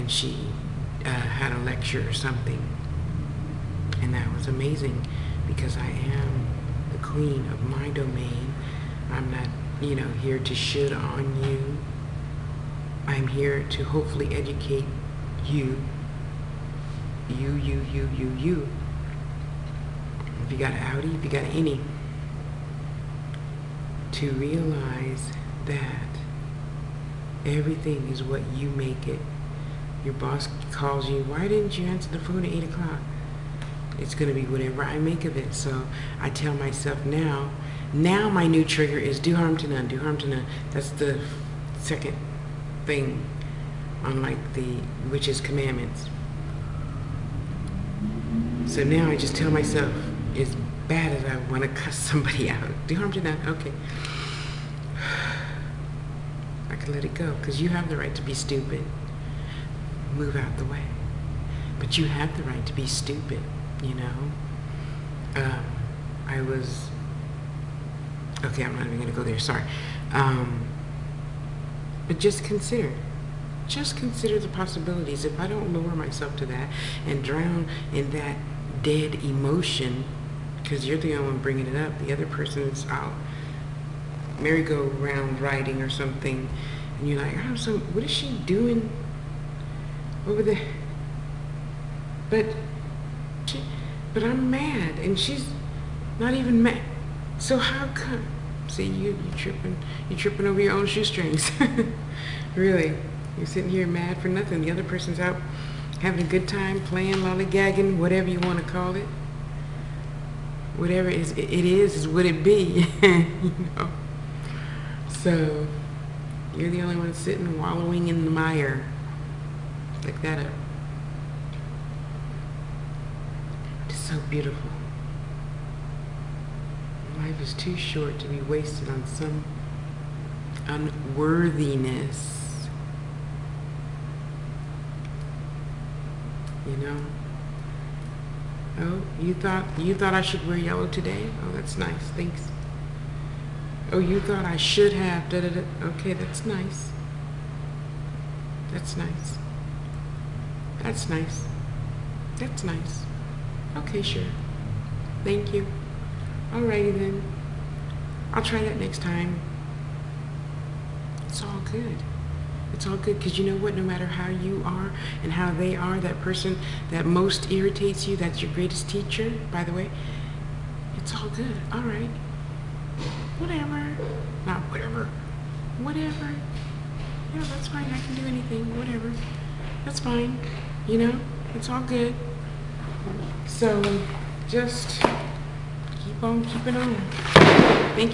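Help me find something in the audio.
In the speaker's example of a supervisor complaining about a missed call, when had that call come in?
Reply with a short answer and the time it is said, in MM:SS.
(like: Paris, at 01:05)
8 o'clock, at 00:32.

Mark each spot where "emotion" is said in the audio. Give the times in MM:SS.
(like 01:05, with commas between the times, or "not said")
01:19.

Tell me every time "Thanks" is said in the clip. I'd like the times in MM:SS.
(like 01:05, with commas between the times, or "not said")
02:22, 02:35.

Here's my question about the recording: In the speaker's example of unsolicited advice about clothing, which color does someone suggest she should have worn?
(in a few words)
yellow.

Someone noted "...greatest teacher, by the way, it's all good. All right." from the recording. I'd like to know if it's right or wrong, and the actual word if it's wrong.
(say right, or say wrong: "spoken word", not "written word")
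right.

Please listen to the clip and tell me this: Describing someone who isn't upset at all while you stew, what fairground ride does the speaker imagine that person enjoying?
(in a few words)
merry-go-round.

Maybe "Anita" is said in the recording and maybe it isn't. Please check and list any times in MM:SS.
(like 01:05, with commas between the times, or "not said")
not said.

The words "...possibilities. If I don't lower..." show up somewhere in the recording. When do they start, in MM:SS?
01:14.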